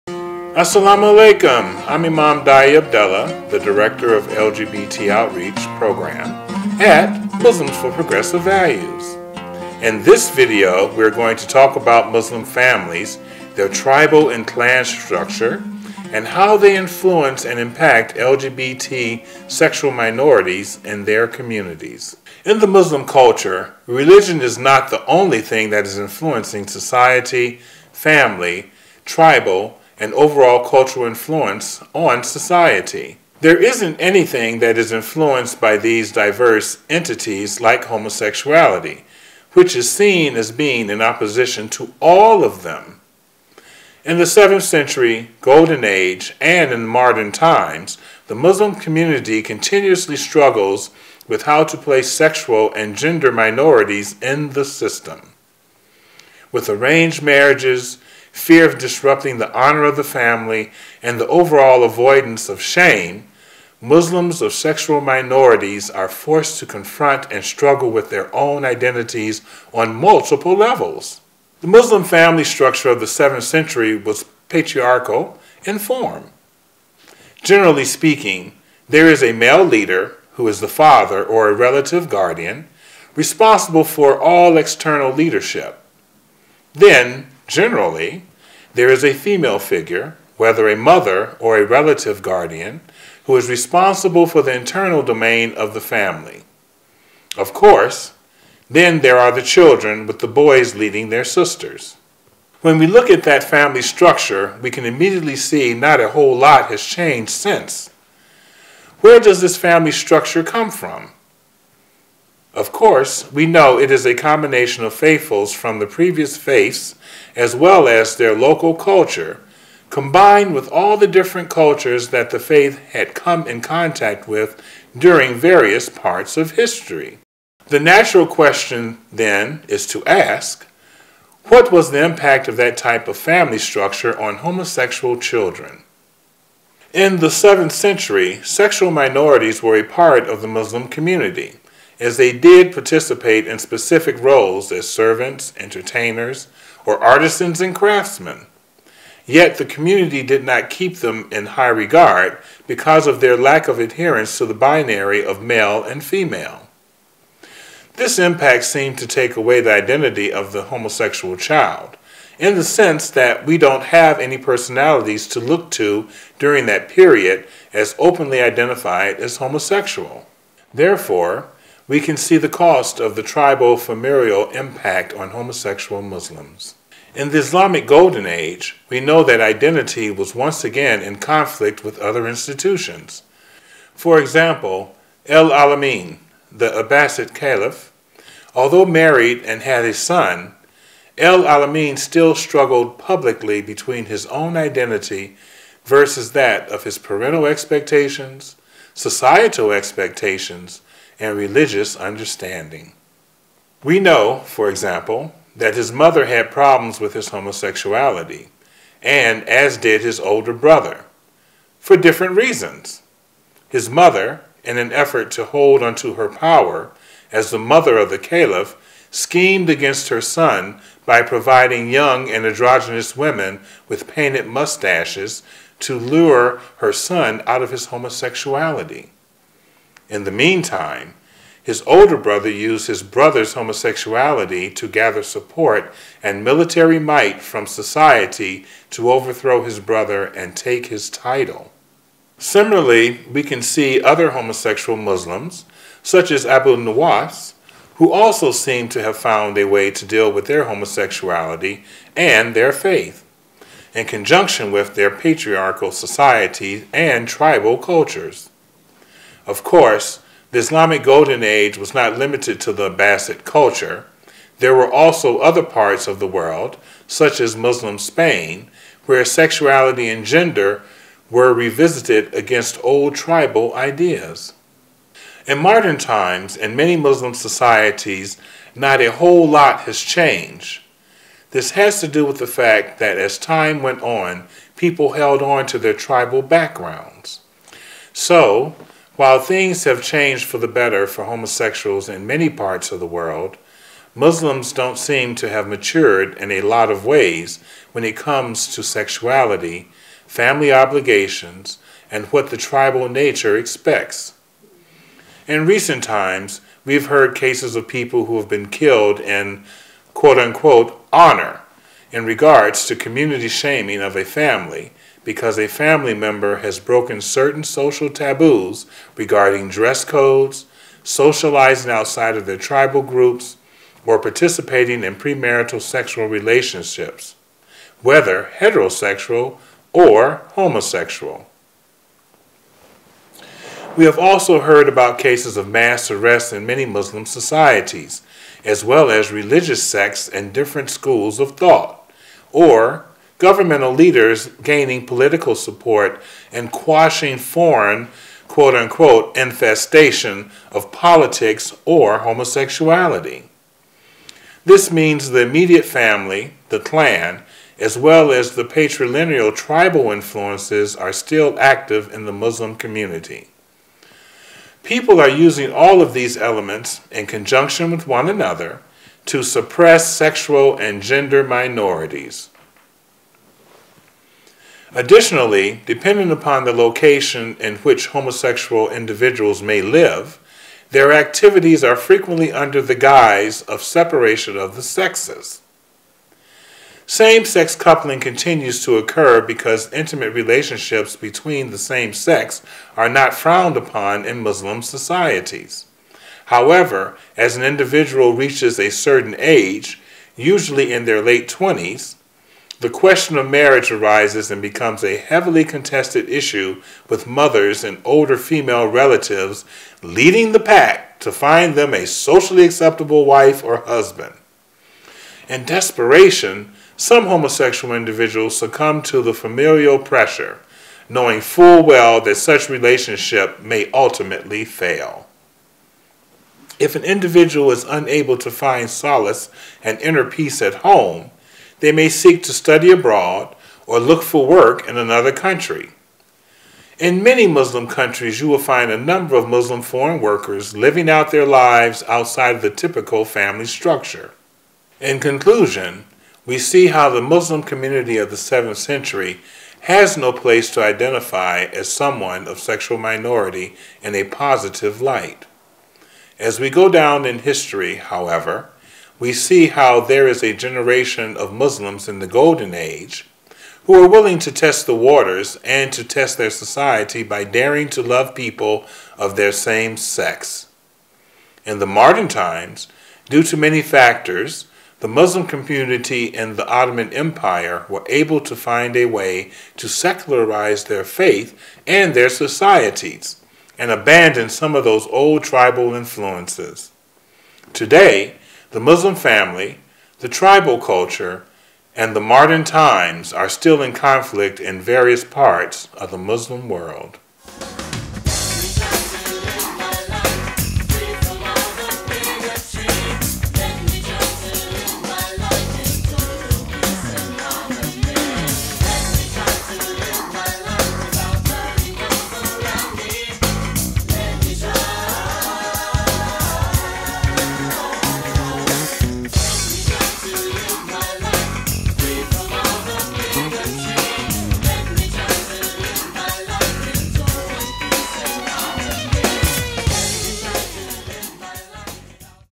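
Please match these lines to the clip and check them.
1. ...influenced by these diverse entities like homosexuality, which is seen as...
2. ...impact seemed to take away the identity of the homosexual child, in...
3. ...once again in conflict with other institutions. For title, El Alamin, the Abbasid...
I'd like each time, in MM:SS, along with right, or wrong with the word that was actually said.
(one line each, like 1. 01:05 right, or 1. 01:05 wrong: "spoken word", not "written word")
1. 00:34 right
2. 02:38 right
3. 03:00 wrong: "example", not "title".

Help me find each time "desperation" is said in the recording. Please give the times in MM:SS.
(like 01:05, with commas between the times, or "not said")
06:55.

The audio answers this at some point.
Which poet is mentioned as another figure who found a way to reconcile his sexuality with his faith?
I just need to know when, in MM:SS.
04:06.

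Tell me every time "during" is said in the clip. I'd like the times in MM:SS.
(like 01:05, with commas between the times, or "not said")
02:04, 02:46.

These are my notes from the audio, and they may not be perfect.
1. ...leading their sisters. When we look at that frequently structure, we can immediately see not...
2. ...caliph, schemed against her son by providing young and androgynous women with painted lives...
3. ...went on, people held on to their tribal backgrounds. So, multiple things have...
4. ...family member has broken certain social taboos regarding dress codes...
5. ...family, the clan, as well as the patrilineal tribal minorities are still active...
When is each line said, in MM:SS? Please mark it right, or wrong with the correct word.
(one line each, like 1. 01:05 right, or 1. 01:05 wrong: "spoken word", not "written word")
1. 01:40 wrong: "family", not "frequently"
2. 03:38 wrong: "mustaches", not "lives"
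3. 04:43 wrong: "while", not "multiple"
4. 05:15 right
5. 05:55 wrong: "influences", not "minorities".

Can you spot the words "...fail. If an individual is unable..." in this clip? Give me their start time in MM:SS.
07:04.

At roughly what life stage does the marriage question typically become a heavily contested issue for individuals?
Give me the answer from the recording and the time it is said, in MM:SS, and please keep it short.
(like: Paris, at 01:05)
late 20s, at 06:41.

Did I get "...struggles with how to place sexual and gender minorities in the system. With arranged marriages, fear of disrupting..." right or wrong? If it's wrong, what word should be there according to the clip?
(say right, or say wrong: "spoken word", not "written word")
right.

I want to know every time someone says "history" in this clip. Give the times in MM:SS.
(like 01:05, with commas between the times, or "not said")
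02:06, 07:37.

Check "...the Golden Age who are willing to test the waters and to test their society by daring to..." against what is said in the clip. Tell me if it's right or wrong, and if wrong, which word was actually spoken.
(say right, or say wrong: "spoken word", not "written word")
right.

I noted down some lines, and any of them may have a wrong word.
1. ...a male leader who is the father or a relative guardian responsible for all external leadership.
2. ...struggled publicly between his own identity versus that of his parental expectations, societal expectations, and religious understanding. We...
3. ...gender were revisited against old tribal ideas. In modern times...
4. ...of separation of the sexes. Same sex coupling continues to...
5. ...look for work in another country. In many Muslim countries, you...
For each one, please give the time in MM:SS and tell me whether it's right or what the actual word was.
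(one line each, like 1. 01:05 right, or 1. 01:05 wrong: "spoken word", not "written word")
1. 01:19 right
2. 03:12 right
3. 04:30 right
4. 06:23 right
5. 07:13 right.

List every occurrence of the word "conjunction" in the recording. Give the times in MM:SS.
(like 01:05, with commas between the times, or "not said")
04:14, 06:07.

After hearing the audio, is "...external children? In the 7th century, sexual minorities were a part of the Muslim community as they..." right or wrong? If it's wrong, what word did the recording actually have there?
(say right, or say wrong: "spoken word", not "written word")
wrong: "homosexual", not "external".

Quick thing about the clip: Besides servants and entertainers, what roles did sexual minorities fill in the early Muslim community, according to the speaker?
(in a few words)
artisans and craftsmen.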